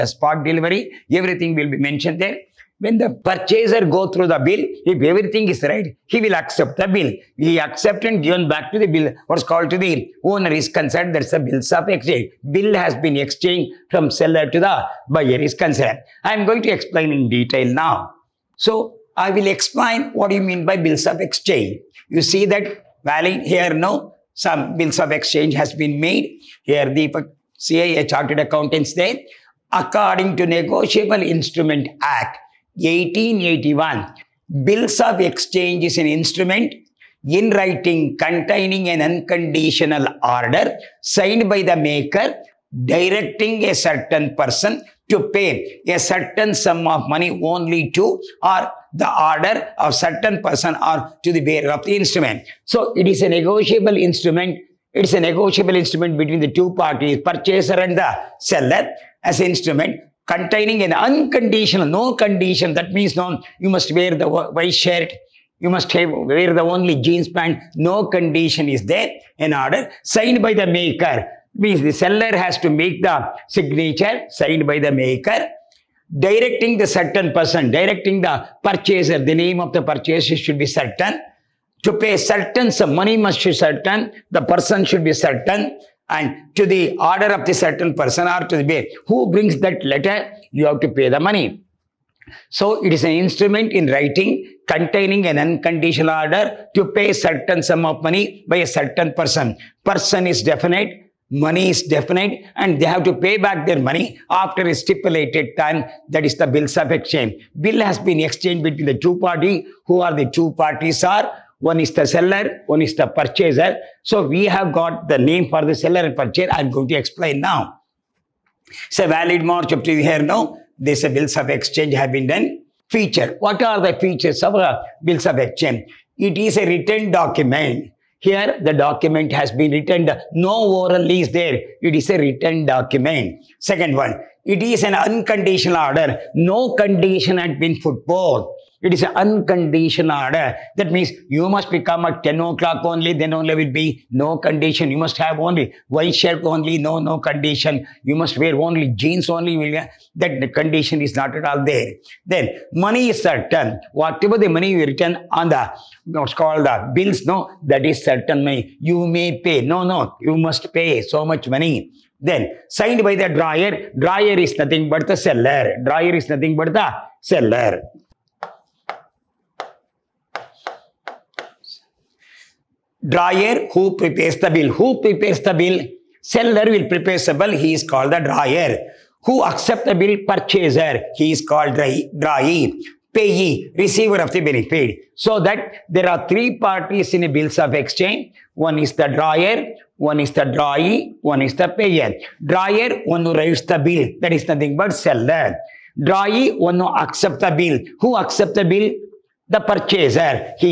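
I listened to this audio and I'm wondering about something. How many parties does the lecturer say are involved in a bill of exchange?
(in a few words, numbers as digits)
3.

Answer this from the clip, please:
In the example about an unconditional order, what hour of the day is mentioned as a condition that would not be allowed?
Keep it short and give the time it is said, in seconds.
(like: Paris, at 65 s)
10 o'clock, at 142 s.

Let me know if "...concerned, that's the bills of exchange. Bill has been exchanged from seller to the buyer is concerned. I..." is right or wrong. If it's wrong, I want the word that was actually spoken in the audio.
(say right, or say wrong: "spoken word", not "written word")
right.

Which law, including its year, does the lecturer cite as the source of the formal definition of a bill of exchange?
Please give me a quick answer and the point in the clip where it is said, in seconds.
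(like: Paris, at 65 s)
Negotiable Instrument Act, 1881, at 30 s.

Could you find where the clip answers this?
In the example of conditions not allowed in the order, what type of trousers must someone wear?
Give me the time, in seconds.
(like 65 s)
67 s.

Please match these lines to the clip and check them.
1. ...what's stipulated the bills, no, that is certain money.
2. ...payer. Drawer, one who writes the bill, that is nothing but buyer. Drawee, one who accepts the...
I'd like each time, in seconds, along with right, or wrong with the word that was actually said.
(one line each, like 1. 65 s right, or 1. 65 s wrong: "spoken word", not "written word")
1. 156 s wrong: "called", not "stipulated"
2. 191 s wrong: "seller", not "buyer".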